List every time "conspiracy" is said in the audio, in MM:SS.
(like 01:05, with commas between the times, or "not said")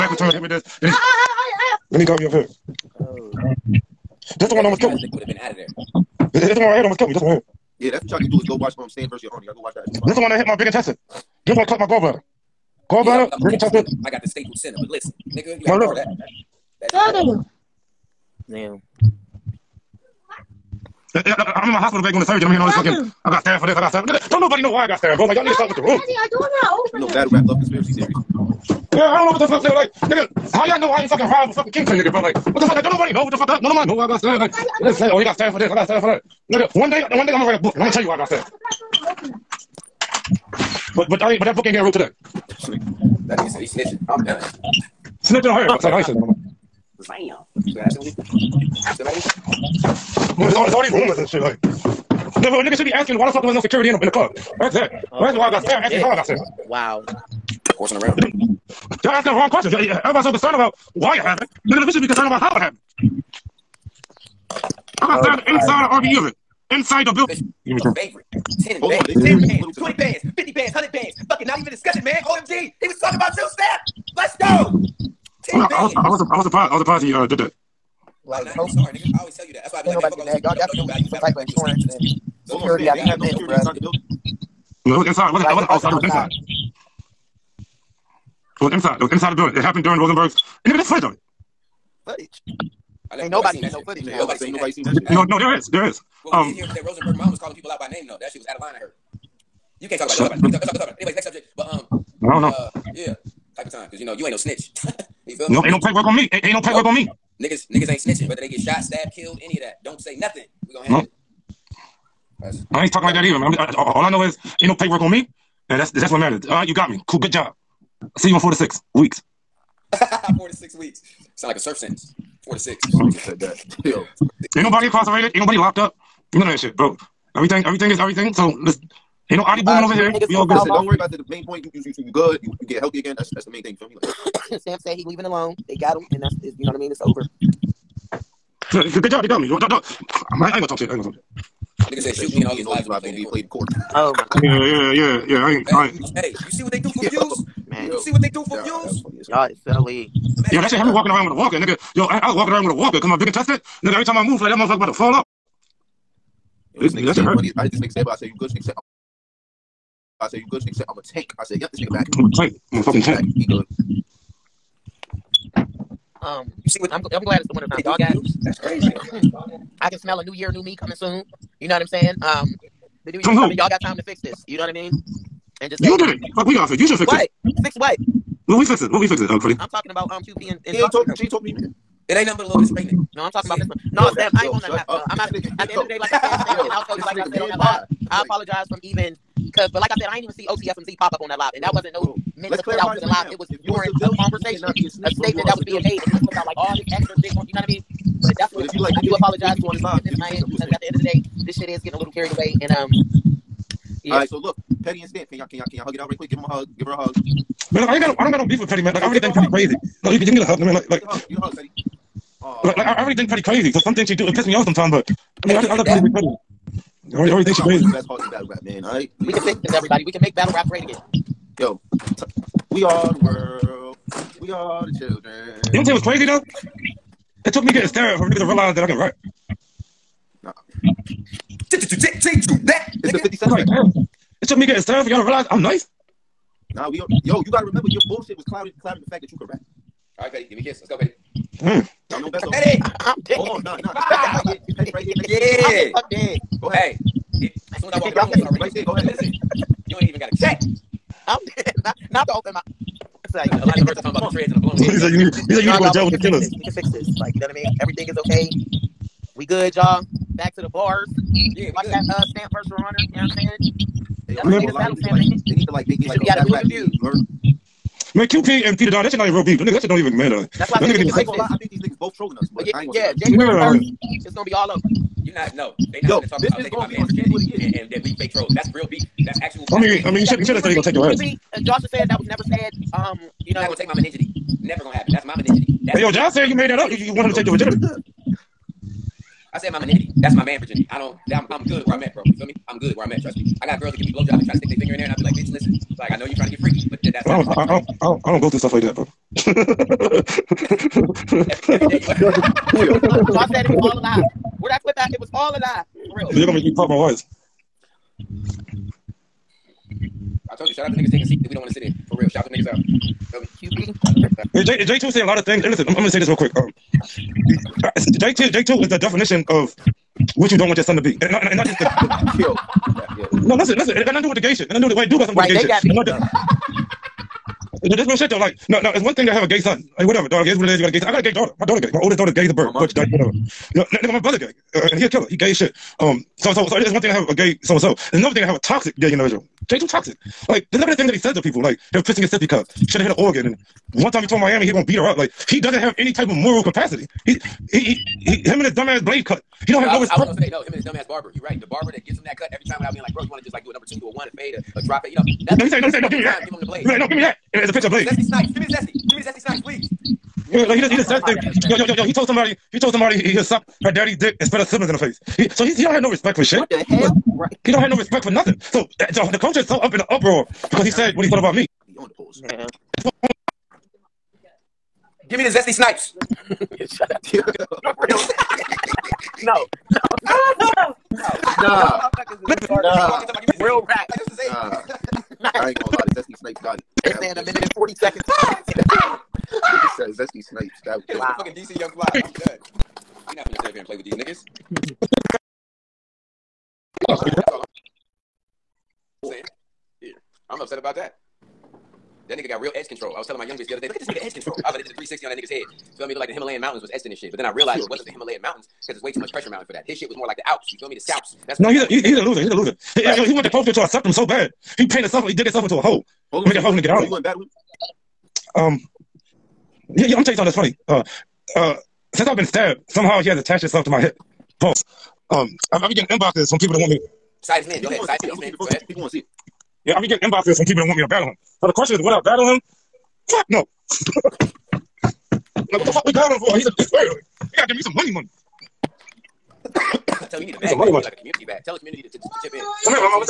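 00:27.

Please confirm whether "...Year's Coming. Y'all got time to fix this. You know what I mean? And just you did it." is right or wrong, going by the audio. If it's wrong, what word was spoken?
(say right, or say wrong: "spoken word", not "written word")
right.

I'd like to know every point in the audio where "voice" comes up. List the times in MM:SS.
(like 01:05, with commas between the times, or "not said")
05:06.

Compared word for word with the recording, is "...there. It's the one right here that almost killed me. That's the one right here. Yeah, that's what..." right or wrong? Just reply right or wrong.
right.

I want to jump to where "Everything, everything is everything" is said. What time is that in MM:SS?
02:07.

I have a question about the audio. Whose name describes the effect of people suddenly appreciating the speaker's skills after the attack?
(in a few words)
50 Cent.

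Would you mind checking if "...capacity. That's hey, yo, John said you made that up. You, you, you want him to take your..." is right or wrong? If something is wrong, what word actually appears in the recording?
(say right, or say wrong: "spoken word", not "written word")
wrong: "virginity", not "capacity".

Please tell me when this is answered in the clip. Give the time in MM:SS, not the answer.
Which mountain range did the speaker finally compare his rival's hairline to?
06:50.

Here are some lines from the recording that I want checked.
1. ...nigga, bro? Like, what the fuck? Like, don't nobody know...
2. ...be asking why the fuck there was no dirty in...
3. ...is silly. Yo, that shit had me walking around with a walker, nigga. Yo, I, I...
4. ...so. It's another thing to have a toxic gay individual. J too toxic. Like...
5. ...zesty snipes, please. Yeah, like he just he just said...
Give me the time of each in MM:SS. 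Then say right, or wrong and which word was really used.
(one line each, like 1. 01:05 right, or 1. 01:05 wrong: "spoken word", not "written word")
1. 00:31 right
2. 00:52 wrong: "security", not "dirty"
3. 02:29 right
4. 05:37 right
5. 05:59 right.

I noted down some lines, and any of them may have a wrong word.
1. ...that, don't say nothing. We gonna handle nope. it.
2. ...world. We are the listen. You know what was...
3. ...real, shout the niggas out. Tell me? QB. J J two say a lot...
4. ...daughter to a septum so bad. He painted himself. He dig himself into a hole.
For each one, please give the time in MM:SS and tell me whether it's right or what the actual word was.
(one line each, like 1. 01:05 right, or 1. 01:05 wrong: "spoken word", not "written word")
1. 01:49 right
2. 03:43 wrong: "children", not "listen"
3. 05:12 right
4. 06:53 wrong: "closer", not "daughter".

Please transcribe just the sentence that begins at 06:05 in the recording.
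He so he he don't have no respect for shit.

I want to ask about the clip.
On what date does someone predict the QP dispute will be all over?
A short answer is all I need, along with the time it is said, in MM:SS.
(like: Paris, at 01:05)
January 1, at 04:33.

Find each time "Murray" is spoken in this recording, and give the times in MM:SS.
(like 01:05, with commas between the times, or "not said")
not said.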